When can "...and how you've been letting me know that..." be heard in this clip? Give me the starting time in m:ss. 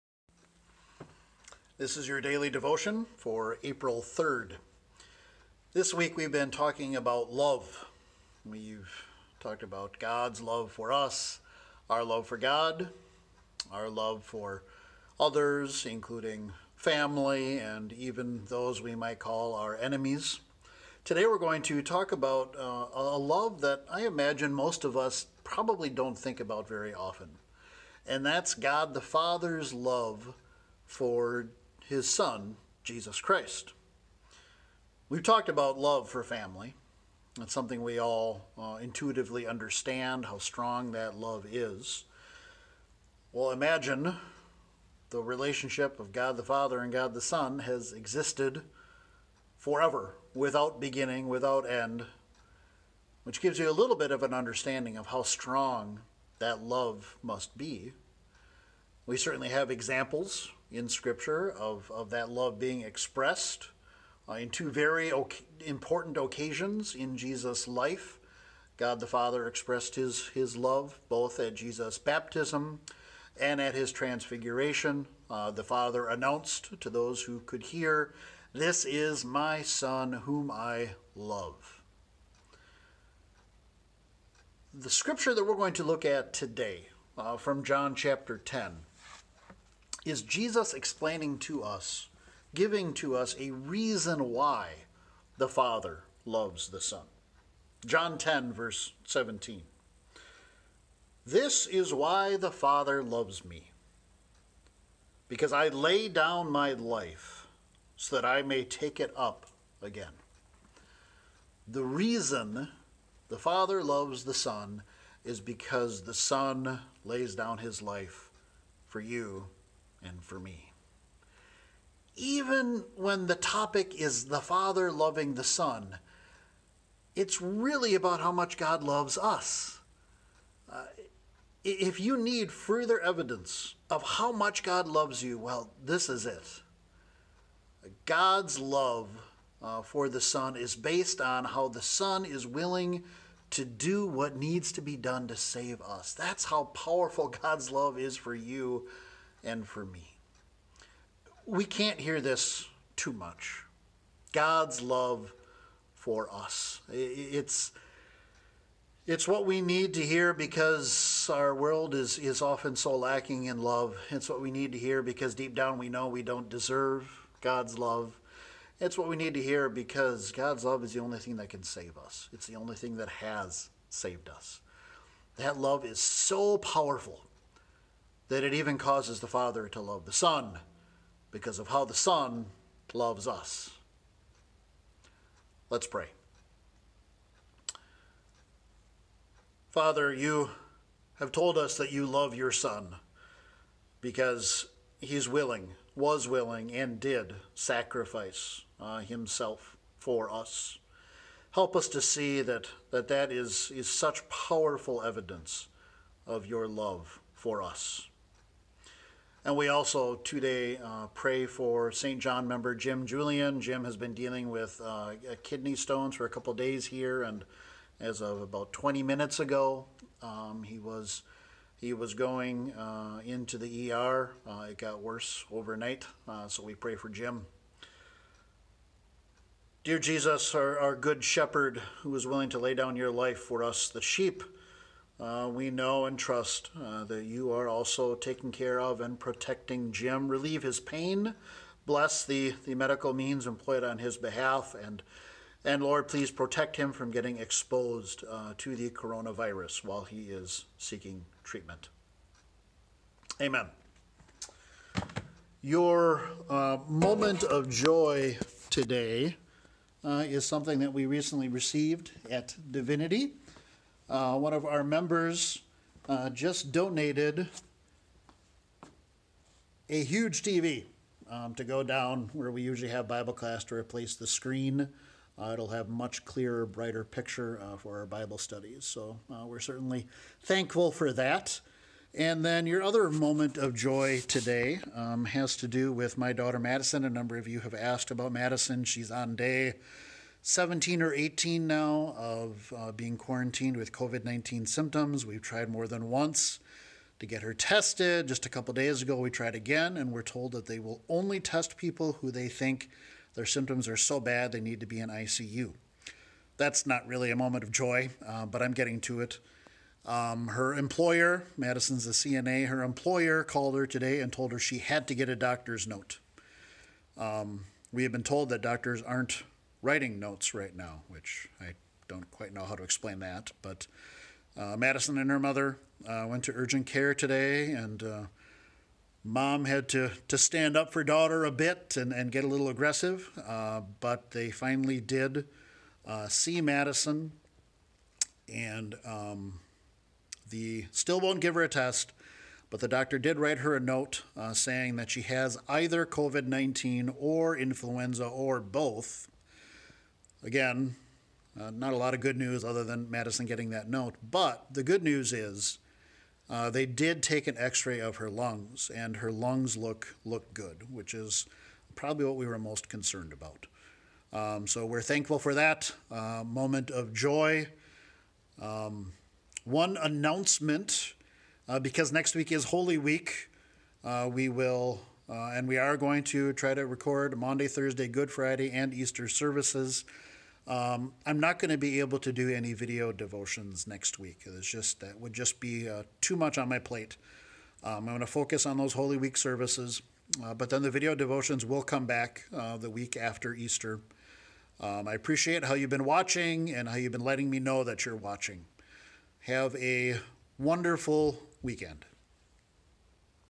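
6:36.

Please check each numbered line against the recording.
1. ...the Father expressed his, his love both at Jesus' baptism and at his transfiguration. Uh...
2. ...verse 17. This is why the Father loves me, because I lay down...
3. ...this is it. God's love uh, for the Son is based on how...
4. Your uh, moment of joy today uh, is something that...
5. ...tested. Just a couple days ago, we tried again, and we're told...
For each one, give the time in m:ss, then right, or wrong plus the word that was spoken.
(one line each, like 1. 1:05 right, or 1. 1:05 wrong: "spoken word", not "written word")
1. 1:08 right
2. 1:38 right
3. 2:15 right
4. 4:15 right
5. 4:57 right.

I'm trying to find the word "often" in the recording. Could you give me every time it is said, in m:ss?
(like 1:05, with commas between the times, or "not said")
0:26, 2:42.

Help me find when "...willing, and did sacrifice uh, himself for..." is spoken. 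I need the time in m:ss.
3:16.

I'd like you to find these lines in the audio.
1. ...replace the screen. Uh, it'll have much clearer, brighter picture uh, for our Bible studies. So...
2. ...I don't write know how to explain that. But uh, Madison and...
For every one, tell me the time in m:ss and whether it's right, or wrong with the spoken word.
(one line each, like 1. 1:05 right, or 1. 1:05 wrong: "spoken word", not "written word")
1. 4:33 right
2. 5:21 wrong: "quite", not "write".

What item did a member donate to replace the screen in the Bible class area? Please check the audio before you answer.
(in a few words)
A huge TV.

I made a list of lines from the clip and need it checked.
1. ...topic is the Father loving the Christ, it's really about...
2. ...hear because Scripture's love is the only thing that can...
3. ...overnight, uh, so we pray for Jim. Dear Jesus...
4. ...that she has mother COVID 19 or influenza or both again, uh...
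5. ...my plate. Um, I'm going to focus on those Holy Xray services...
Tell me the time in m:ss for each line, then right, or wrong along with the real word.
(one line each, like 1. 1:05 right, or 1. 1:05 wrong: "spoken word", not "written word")
1. 2:03 wrong: "Son", not "Christ"
2. 2:49 wrong: "God", not "Scripture"
3. 3:45 right
4. 5:44 wrong: "either", not "mother"
5. 6:26 wrong: "Week", not "Xray".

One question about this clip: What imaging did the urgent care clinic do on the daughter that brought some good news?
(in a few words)
X-ray of her lungs.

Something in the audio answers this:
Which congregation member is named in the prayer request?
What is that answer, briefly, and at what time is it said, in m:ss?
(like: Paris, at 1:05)
Jim Julian, at 3:32.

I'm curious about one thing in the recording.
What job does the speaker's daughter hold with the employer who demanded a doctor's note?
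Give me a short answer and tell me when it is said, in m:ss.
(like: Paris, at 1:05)
CNA, at 5:12.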